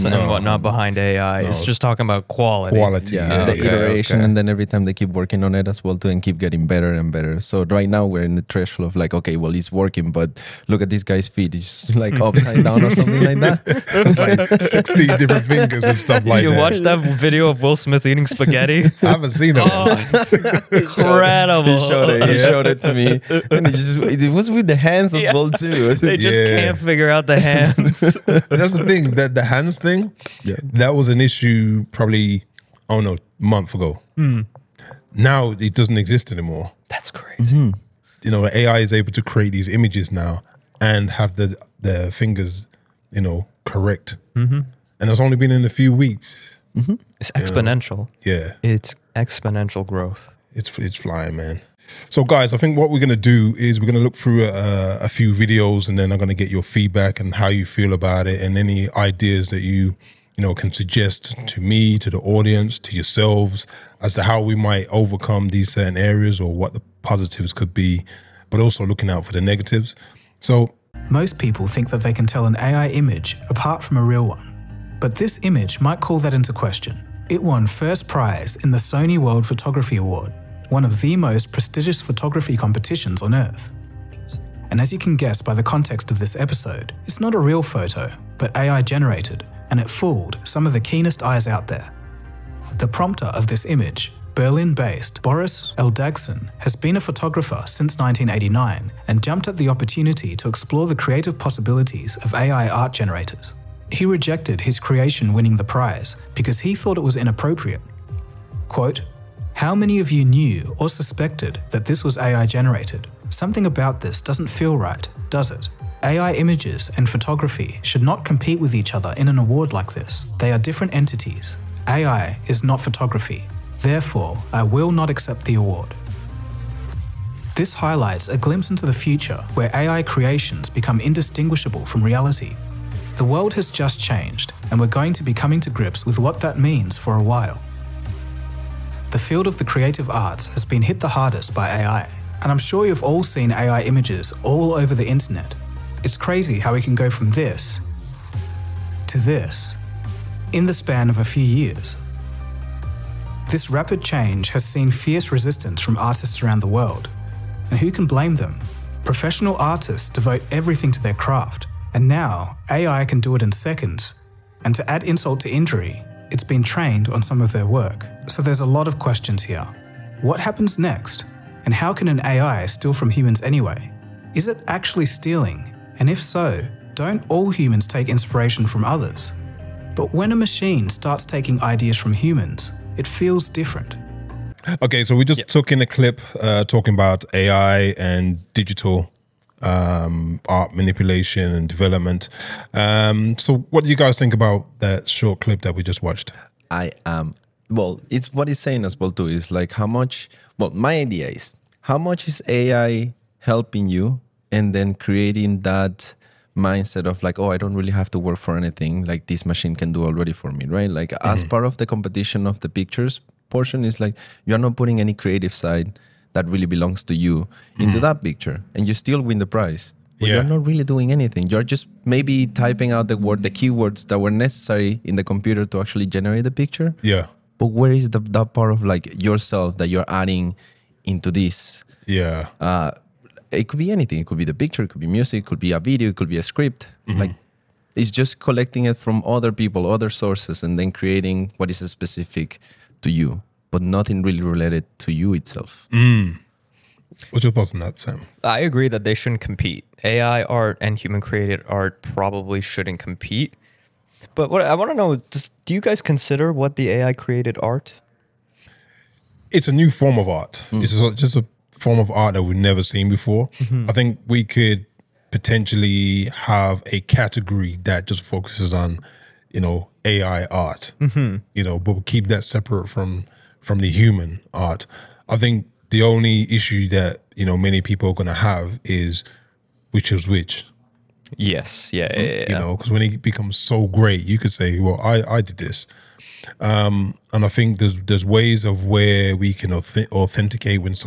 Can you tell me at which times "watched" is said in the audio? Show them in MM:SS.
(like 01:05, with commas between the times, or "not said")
00:16, 03:16.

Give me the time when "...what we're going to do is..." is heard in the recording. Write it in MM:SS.
00:52.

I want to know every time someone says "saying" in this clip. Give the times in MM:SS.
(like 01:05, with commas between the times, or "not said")
03:18.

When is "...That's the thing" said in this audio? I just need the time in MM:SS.
00:27.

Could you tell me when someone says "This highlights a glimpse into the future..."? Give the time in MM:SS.
02:07.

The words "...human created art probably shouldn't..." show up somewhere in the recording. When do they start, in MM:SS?
04:10.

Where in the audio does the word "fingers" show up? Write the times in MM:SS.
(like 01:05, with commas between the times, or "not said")
00:15, 00:42.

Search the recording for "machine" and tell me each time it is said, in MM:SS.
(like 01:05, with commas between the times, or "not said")
03:00, 03:29.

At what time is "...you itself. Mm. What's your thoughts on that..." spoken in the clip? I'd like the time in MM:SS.
04:05.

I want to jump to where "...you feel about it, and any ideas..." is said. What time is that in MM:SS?
00:57.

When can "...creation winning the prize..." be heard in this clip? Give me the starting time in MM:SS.
01:44.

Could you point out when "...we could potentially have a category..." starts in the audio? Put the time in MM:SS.
04:24.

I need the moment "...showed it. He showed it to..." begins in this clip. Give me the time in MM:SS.
00:21.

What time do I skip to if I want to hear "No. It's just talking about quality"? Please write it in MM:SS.
00:01.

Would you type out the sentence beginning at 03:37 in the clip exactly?
that picture and you still win the prize but yeah.